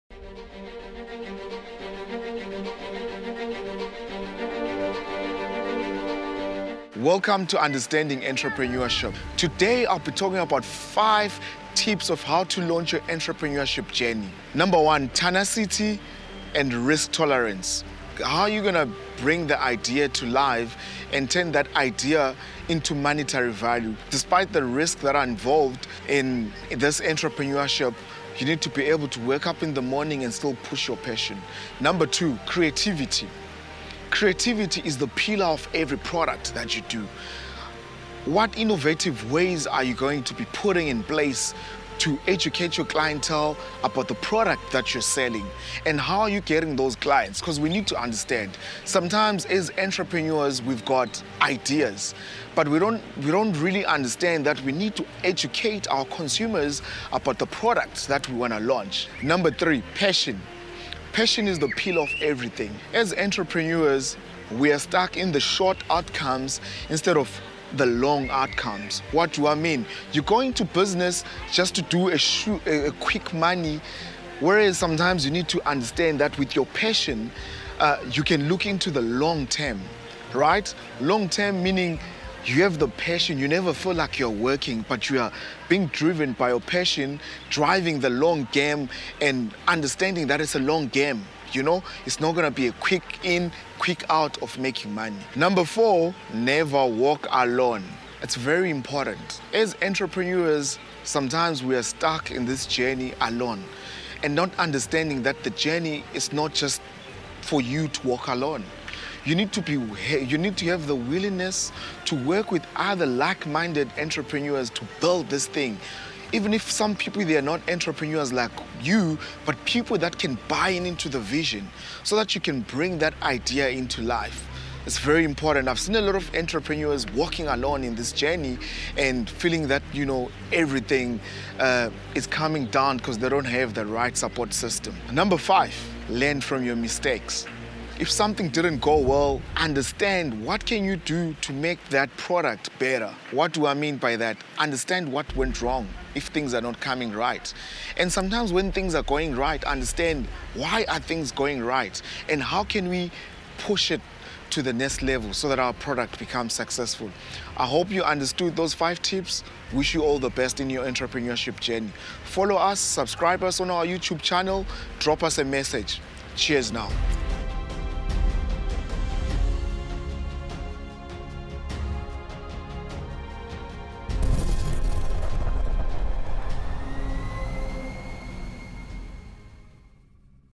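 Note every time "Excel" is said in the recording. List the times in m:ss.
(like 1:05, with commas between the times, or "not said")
not said.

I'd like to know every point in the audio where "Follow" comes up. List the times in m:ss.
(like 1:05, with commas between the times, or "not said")
2:42.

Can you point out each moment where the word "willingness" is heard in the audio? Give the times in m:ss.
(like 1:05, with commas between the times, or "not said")
1:50.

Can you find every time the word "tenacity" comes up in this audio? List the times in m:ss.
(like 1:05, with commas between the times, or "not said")
0:15.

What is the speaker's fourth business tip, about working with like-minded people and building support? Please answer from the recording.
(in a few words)
Never walk alone.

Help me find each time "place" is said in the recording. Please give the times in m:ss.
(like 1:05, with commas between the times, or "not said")
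0:41.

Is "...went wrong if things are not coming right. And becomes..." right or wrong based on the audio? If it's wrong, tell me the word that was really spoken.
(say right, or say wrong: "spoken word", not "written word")
wrong: "sometimes", not "becomes".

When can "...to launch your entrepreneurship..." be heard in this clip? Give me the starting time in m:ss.
0:12.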